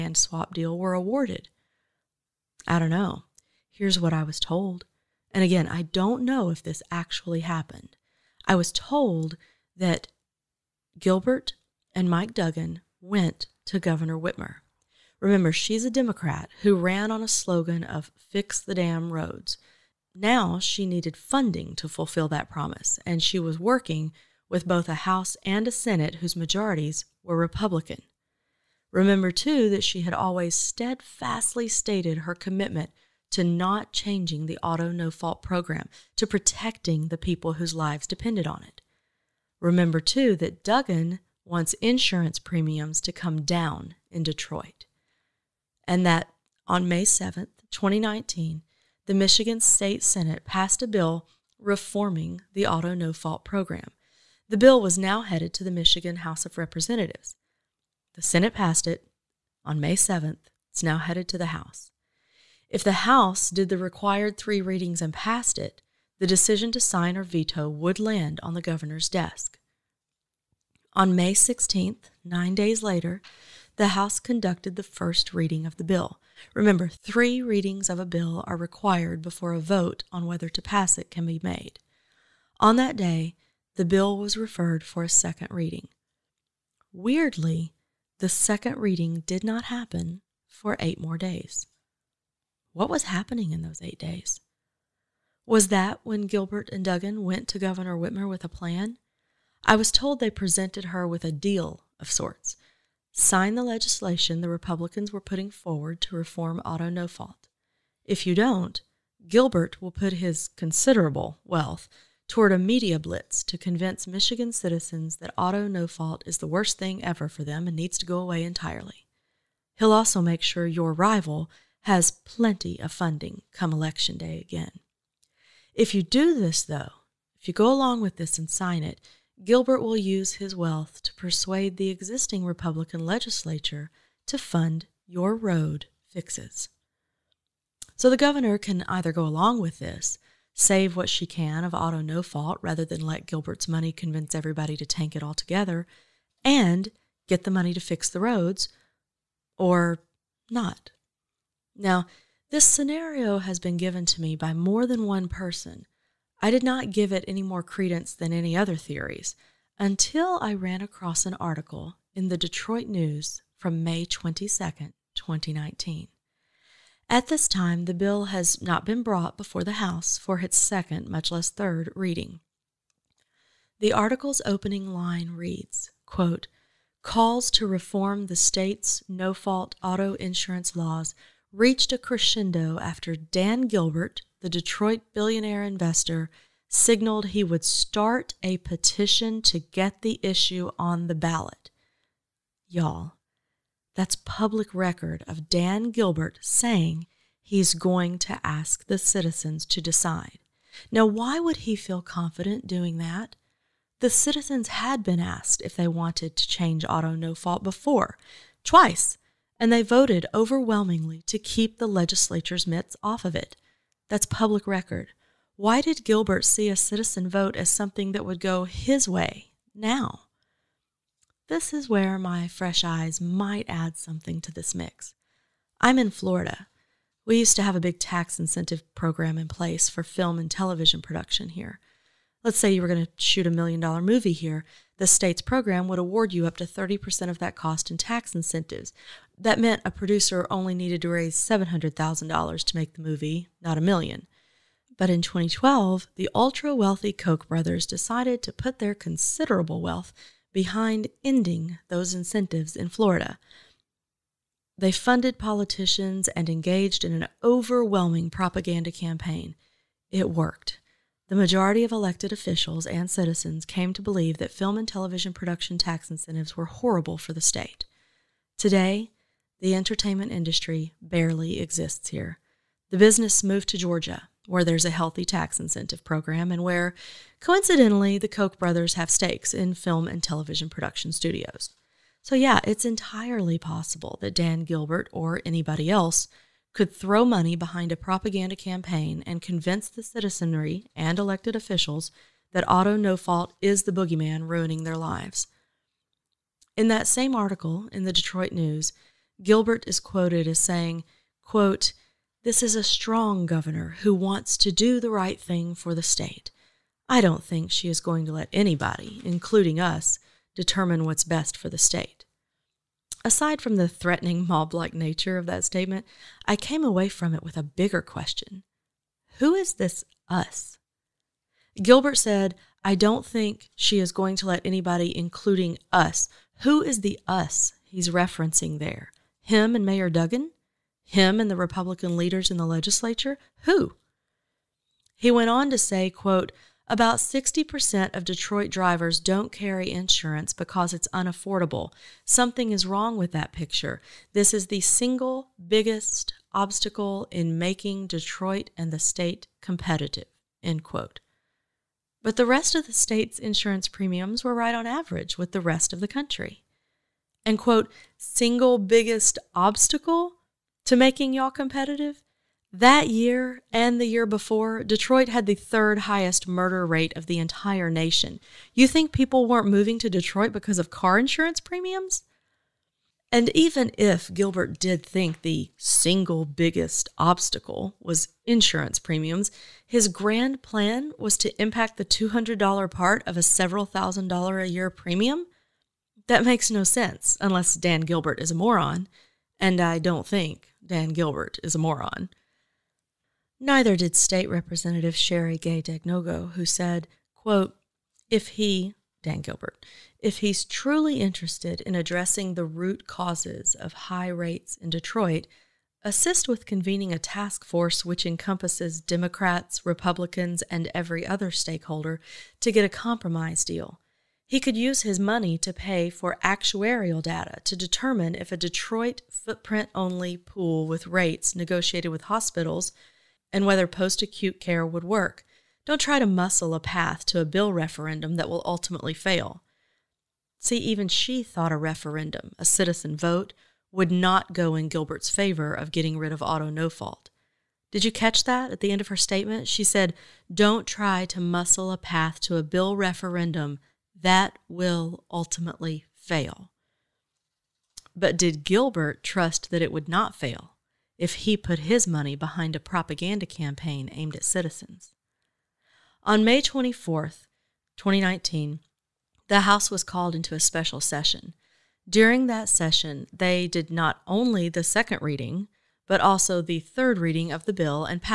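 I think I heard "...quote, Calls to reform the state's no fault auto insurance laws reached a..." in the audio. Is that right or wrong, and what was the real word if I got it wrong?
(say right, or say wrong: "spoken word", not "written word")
right.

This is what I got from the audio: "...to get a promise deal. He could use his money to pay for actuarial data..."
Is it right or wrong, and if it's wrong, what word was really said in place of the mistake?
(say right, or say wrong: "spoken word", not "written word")
wrong: "compromise", not "promise".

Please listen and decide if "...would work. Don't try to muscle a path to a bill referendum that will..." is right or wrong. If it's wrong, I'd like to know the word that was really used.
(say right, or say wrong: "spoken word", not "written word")
right.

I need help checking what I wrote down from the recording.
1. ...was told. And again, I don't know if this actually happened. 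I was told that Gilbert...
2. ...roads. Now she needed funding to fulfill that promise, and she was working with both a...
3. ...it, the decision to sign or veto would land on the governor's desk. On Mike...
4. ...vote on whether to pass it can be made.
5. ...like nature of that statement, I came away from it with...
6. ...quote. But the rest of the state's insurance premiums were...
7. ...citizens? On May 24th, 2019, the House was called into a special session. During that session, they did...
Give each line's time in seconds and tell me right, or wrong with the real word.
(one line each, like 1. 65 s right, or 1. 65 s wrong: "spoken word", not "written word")
1. 4 s right
2. 19 s right
3. 65 s wrong: "May", not "Mike"
4. 79 s right
5. 314 s right
6. 350 s right
7. 454 s right.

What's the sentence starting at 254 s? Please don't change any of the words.
They funded politicians and engaged in an overwhelming propaganda campaign.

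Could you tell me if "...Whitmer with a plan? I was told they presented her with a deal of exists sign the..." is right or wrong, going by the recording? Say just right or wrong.
wrong.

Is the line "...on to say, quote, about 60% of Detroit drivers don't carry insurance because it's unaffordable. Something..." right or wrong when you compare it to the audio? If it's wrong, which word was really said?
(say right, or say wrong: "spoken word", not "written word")
right.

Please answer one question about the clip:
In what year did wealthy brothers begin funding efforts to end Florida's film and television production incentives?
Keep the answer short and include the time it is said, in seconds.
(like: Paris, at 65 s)
2012, at 245 s.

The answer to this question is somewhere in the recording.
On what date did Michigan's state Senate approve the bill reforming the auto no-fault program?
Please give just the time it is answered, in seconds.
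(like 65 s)
46 s.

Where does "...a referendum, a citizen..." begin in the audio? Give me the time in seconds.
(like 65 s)
431 s.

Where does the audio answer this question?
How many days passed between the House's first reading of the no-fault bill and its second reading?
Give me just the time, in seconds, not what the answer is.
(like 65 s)
90 s.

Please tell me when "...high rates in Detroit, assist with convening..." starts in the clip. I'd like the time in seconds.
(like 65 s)
403 s.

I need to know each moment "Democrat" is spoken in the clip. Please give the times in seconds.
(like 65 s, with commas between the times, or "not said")
15 s, 408 s.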